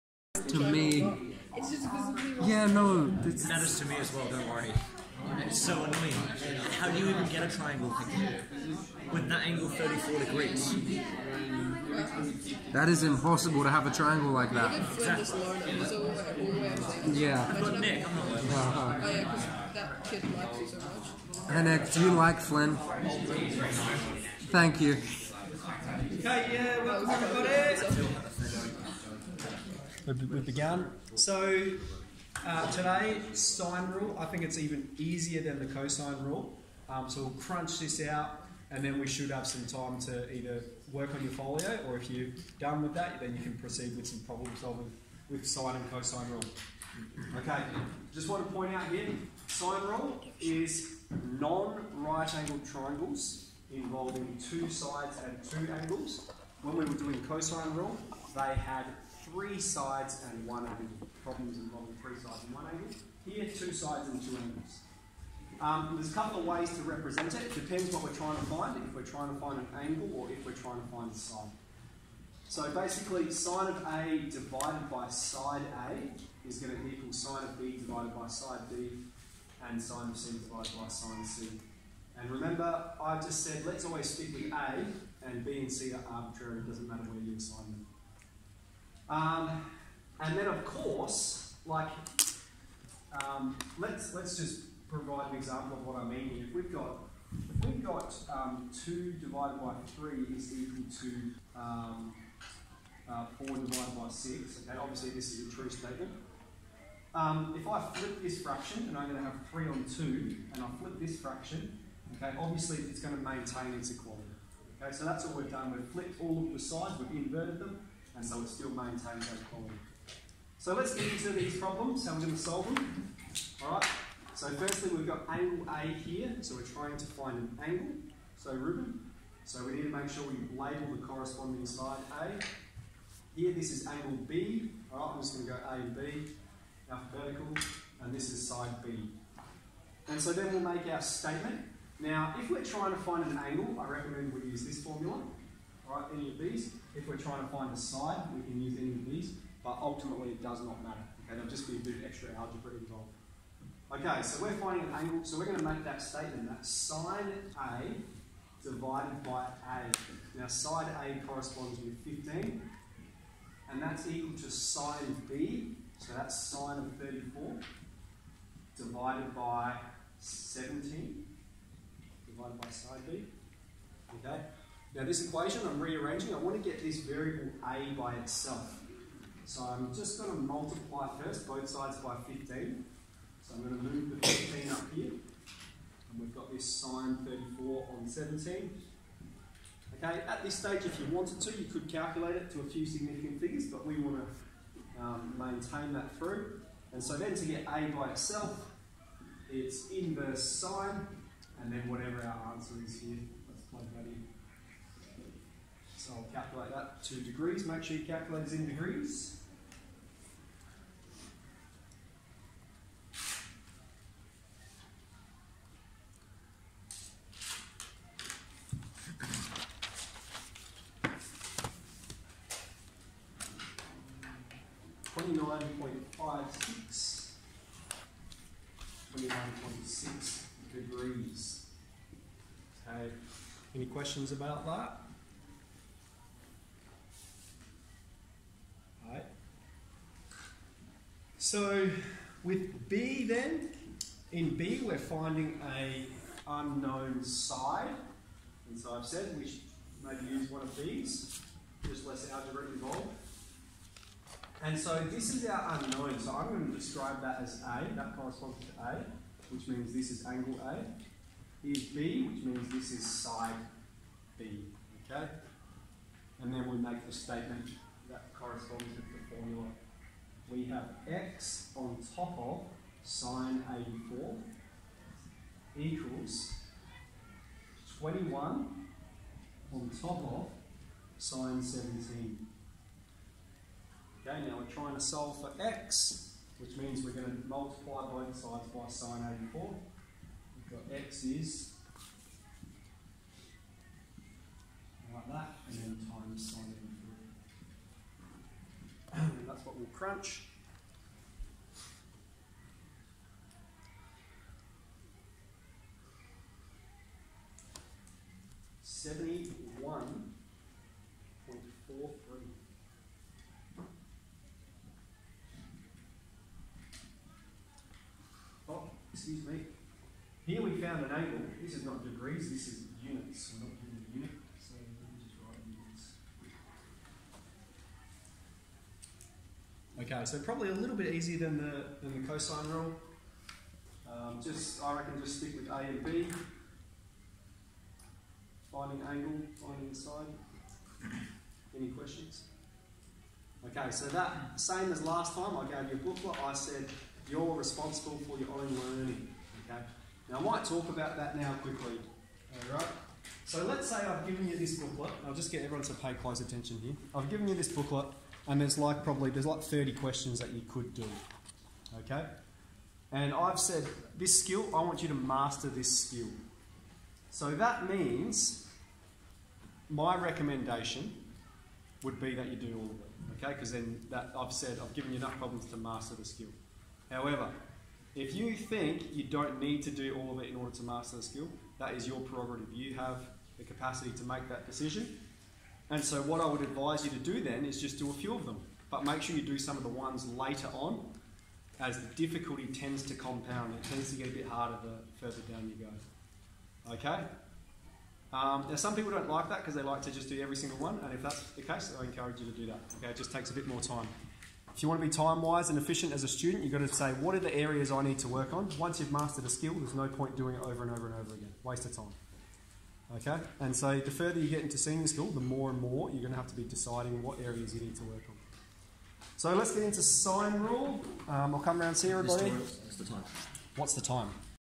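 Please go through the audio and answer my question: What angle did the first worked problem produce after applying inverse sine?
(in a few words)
29.5 degrees.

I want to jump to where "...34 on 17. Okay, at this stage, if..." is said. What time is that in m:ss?
3:07.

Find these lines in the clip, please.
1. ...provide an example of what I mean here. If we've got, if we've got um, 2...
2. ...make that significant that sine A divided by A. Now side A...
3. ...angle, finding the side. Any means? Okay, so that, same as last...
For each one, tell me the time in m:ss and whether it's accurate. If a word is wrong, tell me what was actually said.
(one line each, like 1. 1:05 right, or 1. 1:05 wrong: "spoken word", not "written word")
1. 1:34 right
2. 2:35 wrong: "statement", not "significant"
3. 5:39 wrong: "questions", not "means".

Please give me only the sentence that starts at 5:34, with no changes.
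Um, just, I reckon just stick with A and B.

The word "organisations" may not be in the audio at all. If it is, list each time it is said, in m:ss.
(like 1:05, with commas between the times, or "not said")
not said.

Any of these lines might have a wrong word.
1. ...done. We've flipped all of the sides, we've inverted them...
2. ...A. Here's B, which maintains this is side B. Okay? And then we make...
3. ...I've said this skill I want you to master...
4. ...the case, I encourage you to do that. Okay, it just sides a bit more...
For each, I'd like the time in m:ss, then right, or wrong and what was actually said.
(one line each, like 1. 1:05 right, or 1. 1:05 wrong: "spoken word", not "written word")
1. 1:55 right
2. 4:20 wrong: "means", not "maintains"
3. 6:03 right
4. 6:41 wrong: "takes", not "sides".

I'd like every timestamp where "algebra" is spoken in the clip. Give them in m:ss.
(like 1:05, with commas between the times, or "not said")
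2:32, 4:12.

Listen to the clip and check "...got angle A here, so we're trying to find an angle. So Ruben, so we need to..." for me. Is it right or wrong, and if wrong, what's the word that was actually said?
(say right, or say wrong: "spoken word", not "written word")
right.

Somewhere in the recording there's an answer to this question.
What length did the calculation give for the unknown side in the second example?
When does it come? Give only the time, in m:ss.
5:08.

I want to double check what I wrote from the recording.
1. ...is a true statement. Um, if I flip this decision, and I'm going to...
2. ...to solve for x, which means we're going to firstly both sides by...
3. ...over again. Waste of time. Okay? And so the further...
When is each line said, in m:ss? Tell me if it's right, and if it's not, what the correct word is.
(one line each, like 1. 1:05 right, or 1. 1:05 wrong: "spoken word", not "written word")
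1. 1:45 wrong: "fraction", not "decision"
2. 4:44 wrong: "multiply", not "firstly"
3. 6:51 right.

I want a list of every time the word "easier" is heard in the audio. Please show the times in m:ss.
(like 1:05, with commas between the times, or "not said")
0:34, 5:31.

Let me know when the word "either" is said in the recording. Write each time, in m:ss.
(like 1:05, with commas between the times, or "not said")
0:40.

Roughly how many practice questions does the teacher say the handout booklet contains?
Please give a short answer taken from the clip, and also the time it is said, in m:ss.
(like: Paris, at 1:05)
30, at 5:59.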